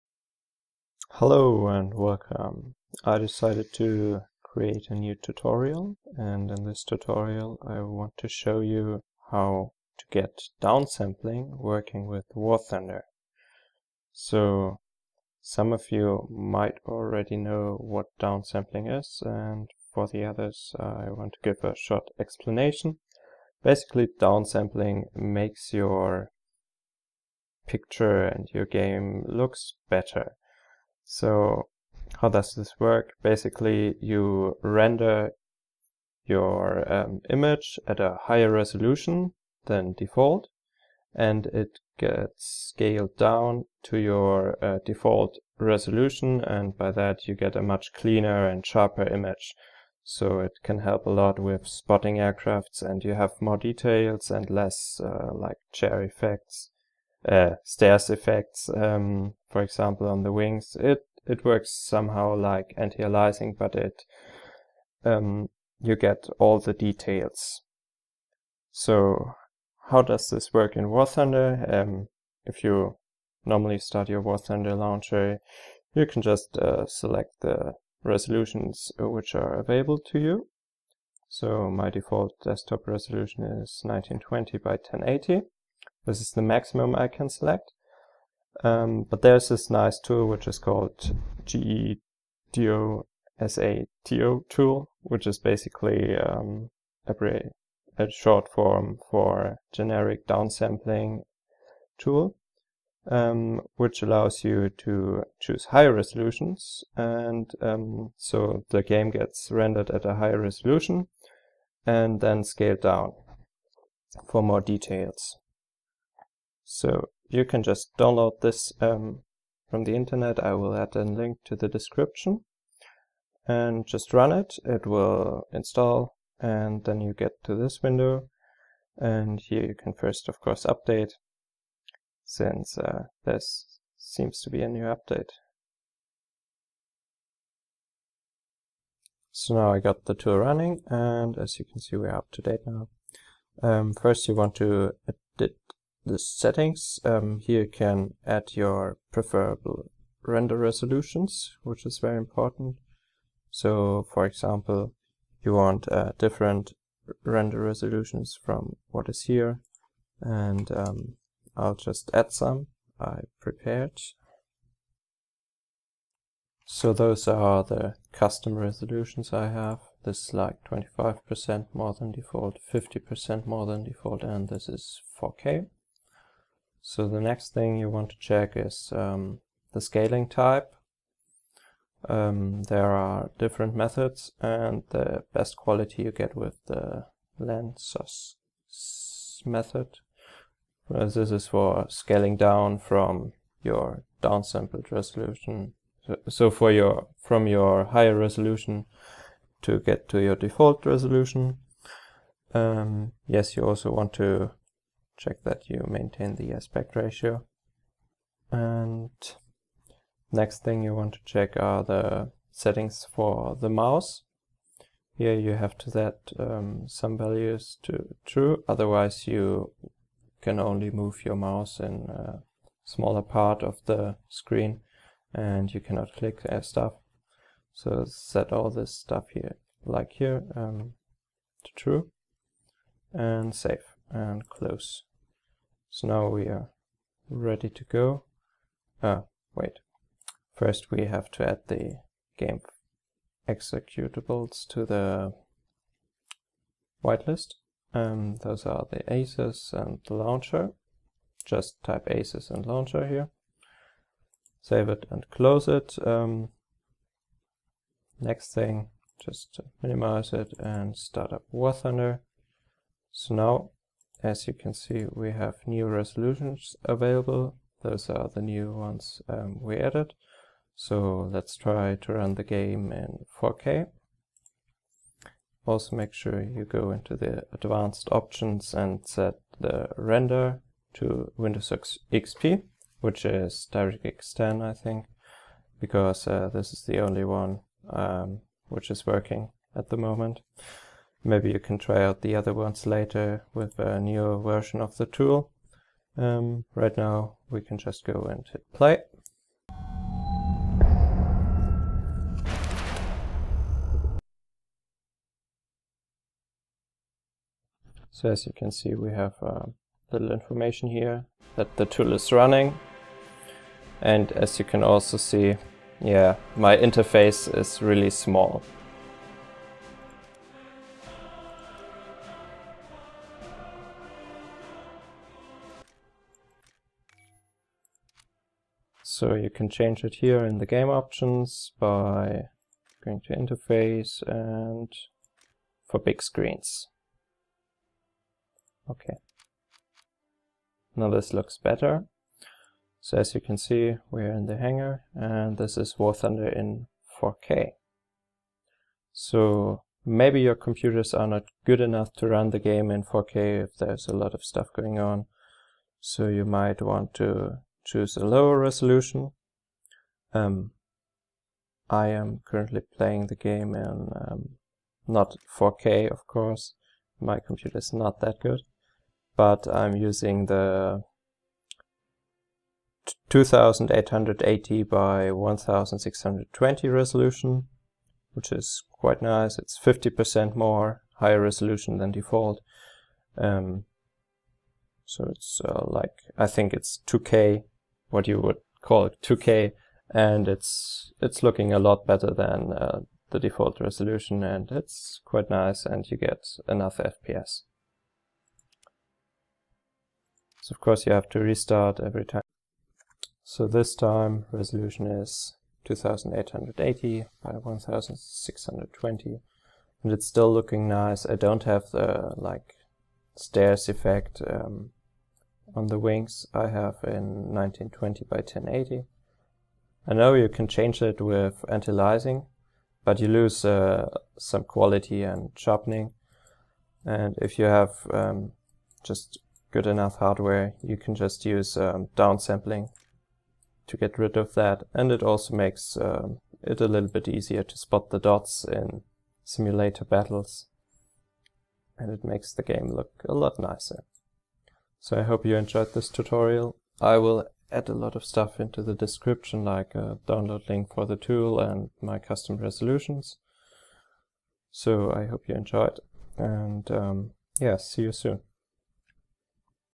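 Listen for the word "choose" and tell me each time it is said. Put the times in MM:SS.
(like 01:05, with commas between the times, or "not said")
01:45, 05:57.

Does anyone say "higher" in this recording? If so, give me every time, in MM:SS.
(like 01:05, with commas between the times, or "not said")
00:38, 01:45, 01:50, 03:17, 06:21.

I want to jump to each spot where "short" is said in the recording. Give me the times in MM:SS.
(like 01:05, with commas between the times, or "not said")
00:21, 01:38.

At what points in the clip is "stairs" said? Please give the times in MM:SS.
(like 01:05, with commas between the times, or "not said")
00:57, 06:53.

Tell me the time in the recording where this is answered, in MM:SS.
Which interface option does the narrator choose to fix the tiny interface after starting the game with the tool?
05:35.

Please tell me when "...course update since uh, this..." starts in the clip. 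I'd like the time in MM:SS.
02:10.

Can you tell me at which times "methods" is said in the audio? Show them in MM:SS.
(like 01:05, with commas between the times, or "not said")
03:03, 03:09.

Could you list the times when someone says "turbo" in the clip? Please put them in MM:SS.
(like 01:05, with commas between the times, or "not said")
not said.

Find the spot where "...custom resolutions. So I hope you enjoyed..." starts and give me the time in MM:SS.
07:32.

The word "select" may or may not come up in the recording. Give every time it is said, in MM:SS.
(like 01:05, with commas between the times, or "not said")
01:16, 01:27.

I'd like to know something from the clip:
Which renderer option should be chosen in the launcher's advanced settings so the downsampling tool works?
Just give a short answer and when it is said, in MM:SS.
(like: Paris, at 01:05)
Windows XP, at 04:41.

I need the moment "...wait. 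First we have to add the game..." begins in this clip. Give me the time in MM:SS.
03:59.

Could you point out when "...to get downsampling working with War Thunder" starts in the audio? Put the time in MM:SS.
00:09.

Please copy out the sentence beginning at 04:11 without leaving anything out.
Just type ACES and launcher here.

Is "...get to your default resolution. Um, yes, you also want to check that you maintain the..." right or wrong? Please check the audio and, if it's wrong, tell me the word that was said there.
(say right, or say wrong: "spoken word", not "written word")
right.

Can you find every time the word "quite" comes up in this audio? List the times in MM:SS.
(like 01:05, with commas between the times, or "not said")
06:18, 06:35.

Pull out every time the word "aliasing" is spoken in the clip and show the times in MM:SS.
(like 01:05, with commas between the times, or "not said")
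01:02, 07:01.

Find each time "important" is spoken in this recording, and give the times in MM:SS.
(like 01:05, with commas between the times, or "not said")
02:32.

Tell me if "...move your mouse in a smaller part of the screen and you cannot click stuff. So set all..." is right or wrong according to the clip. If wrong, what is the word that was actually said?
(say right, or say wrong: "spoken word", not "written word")
right.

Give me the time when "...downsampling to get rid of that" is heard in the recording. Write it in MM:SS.
07:12.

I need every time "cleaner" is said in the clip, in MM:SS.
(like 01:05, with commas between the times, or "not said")
00:47.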